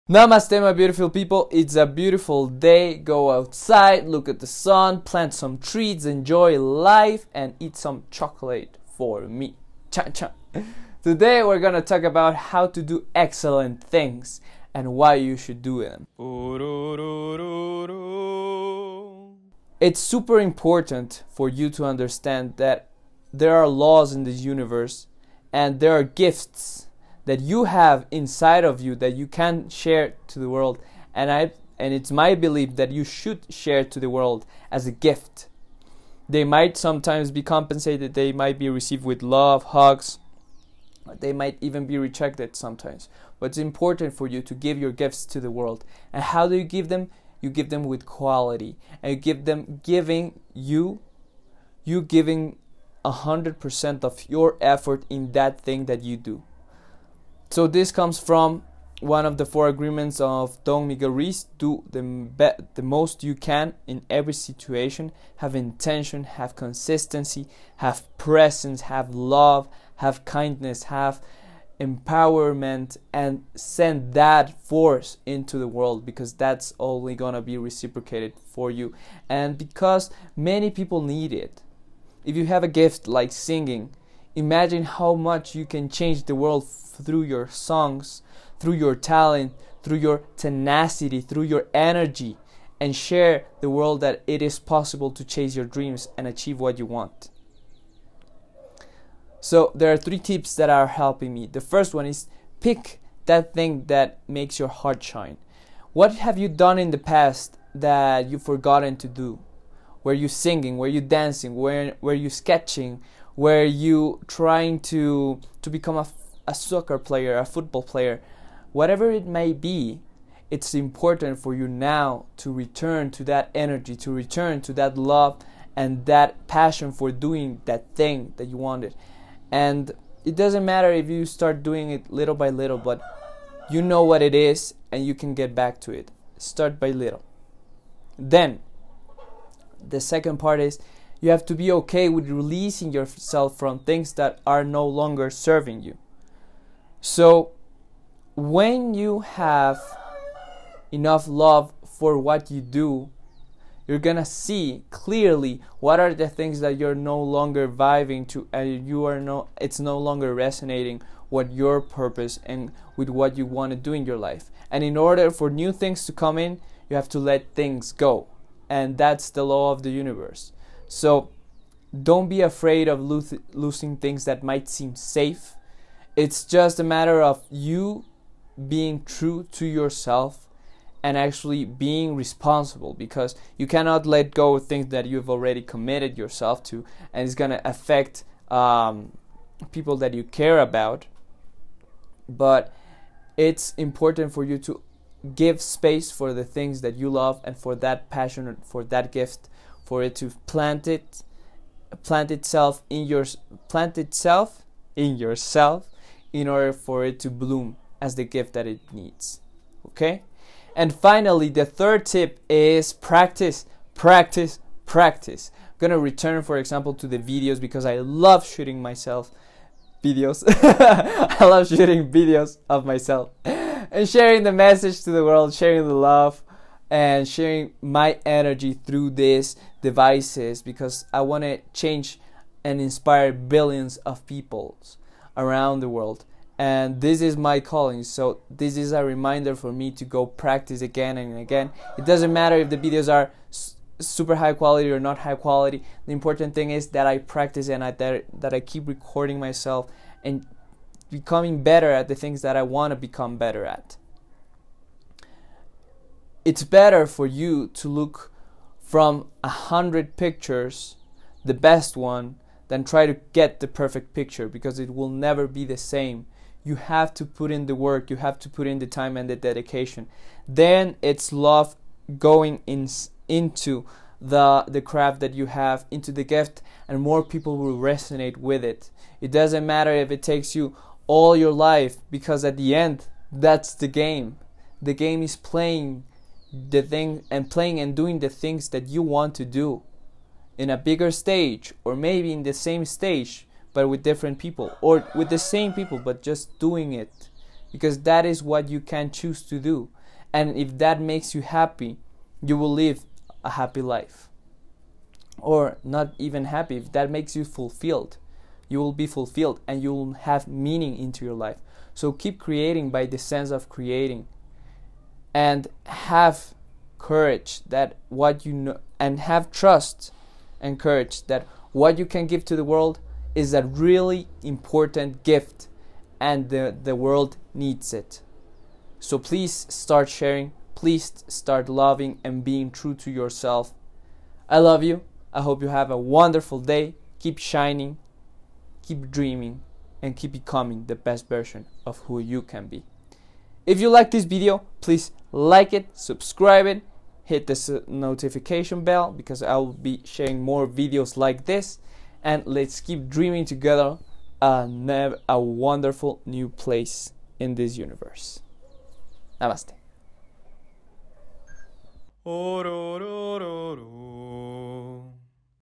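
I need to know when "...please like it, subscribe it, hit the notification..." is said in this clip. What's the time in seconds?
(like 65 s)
344 s.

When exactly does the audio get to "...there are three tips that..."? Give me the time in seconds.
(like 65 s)
99 s.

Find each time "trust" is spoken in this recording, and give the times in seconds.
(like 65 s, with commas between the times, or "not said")
319 s.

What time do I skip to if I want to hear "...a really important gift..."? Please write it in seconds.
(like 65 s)
323 s.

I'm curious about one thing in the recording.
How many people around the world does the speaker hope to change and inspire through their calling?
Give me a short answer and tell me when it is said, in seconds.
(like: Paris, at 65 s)
billions, at 233 s.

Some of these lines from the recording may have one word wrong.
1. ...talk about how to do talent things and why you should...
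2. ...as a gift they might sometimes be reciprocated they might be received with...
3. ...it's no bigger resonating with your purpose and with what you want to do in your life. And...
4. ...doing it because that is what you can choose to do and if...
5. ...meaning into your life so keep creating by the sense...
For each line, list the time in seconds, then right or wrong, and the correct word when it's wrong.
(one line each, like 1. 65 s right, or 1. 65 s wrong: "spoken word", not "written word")
1. 11 s wrong: "excellent", not "talent"
2. 34 s wrong: "compensated", not "reciprocated"
3. 159 s wrong: "longer", not "bigger"
4. 296 s right
5. 310 s right.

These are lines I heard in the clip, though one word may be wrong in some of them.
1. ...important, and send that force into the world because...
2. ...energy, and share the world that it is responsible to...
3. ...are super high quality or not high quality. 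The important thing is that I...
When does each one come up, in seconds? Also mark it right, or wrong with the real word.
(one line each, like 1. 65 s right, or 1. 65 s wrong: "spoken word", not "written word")
1. 71 s wrong: "empowerment", not "important"
2. 91 s wrong: "possible", not "responsible"
3. 243 s right.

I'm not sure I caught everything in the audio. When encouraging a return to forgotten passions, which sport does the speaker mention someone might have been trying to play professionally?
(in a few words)
soccer.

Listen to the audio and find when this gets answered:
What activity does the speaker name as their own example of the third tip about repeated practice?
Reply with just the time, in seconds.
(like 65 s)
221 s.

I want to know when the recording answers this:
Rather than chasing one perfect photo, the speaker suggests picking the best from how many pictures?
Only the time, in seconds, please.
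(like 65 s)
259 s.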